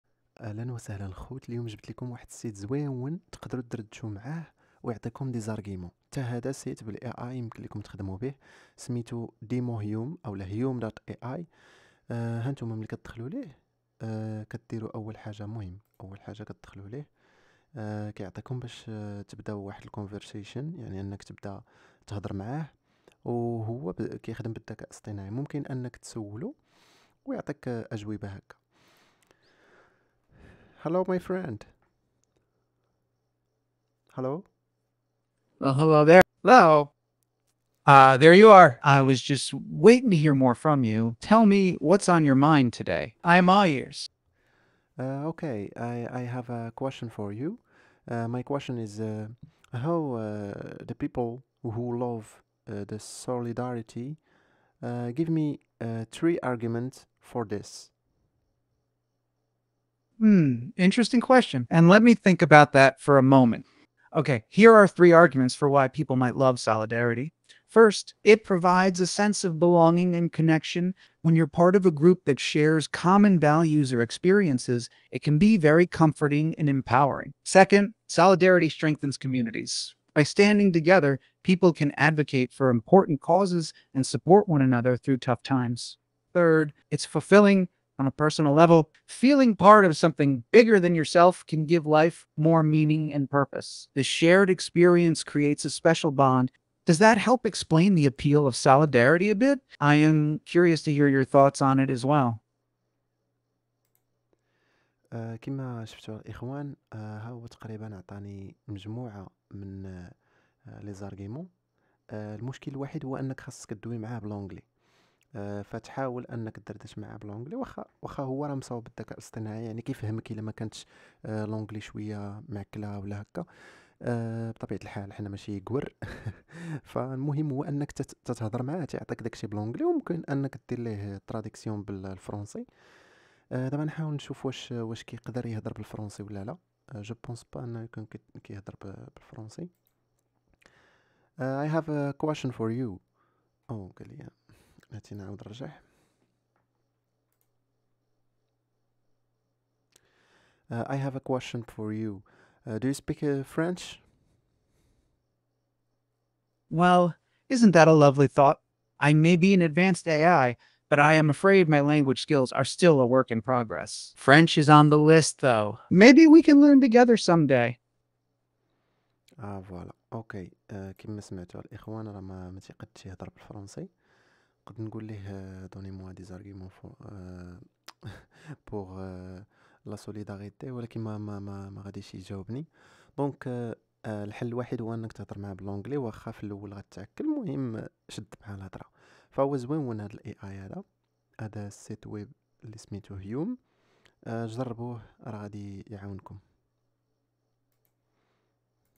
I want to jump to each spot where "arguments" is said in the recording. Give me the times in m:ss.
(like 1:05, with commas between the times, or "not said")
0:56, 1:05.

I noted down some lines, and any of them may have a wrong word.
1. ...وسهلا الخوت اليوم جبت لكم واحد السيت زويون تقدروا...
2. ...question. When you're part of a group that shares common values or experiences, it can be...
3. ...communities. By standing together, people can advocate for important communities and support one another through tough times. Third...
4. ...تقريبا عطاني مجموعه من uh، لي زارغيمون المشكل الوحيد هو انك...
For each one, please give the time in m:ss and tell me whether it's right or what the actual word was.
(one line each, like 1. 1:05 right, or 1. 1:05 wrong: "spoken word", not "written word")
1. 0:00 right
2. 1:10 wrong: "connection", not "question"
3. 1:19 wrong: "causes", not "communities"
4. 1:47 right.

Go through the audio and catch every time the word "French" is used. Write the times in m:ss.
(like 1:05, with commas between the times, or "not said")
2:33, 2:44.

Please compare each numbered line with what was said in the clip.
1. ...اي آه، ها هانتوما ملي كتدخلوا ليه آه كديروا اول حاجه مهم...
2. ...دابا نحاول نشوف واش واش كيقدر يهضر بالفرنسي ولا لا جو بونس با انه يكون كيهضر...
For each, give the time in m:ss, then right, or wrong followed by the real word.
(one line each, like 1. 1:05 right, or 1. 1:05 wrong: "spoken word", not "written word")
1. 0:11 right
2. 2:13 right.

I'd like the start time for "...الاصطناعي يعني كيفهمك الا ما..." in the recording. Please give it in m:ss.
1:59.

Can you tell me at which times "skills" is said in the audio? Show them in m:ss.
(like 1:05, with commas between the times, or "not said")
2:42.